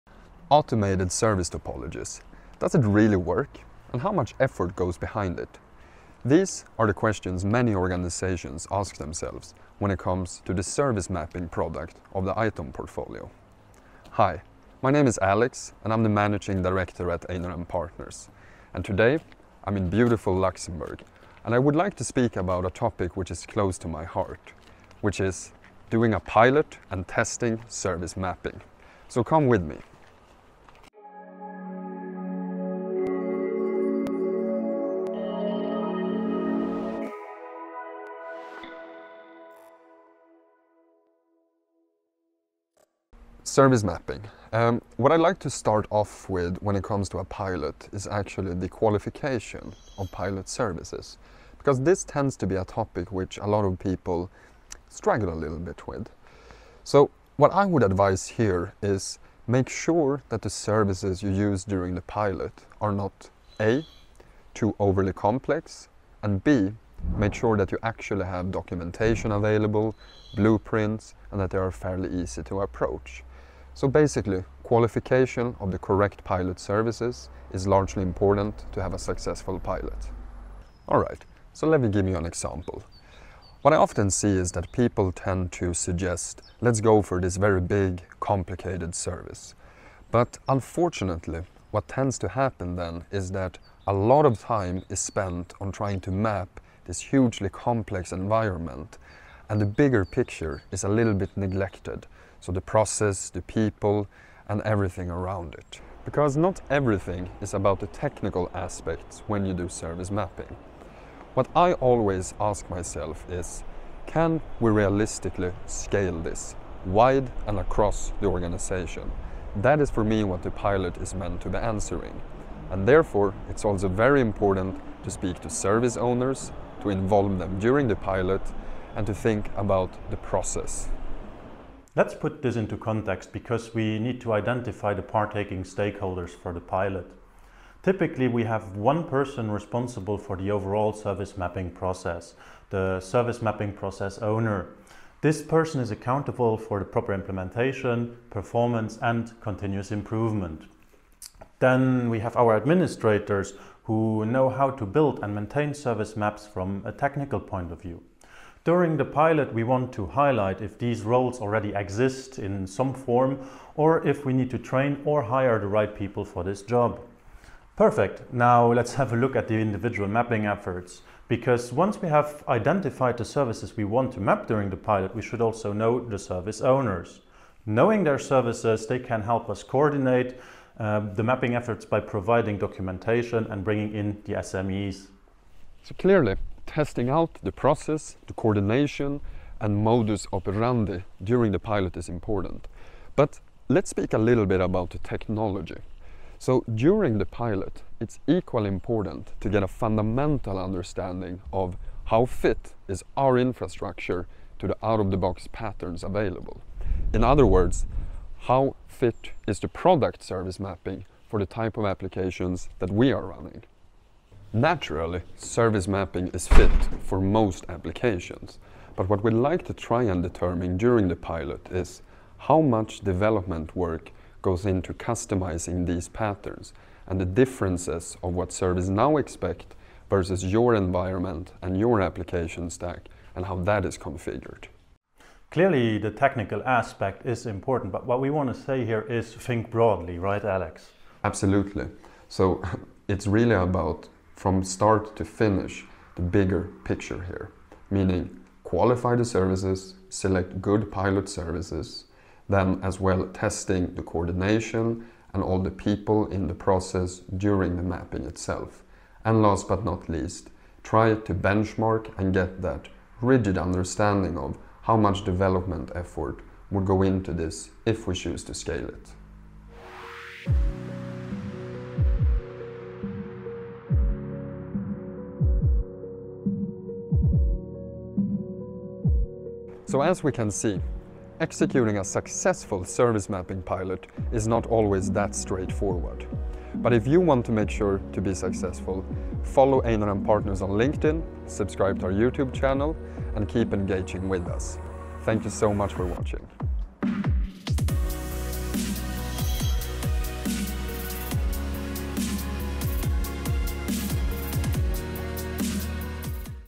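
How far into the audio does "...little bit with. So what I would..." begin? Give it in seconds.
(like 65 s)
55 s.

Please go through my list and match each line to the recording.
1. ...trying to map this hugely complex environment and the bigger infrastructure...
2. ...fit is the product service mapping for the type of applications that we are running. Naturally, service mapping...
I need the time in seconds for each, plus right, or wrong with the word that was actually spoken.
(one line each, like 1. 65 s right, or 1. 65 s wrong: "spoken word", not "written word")
1. 95 s wrong: "picture", not "infrastructure"
2. 208 s right.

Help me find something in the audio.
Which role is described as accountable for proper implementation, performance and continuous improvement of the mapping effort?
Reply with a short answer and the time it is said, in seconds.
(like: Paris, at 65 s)
service mapping process owner, at 143 s.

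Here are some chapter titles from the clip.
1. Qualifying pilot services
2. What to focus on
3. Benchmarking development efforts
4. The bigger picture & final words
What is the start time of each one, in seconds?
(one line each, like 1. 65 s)
1. 45 s
2. 130 s
3. 187 s
4. 235 s.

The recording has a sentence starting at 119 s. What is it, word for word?
That is for me what the pilot is meant to be answering.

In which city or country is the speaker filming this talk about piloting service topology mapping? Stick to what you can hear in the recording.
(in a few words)
Luxembourg.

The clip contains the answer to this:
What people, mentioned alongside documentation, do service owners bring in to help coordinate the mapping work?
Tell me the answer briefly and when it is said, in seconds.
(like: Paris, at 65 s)
SMEs, at 184 s.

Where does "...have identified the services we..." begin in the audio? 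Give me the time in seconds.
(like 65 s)
172 s.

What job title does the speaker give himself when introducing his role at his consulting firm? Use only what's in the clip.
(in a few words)
managing director.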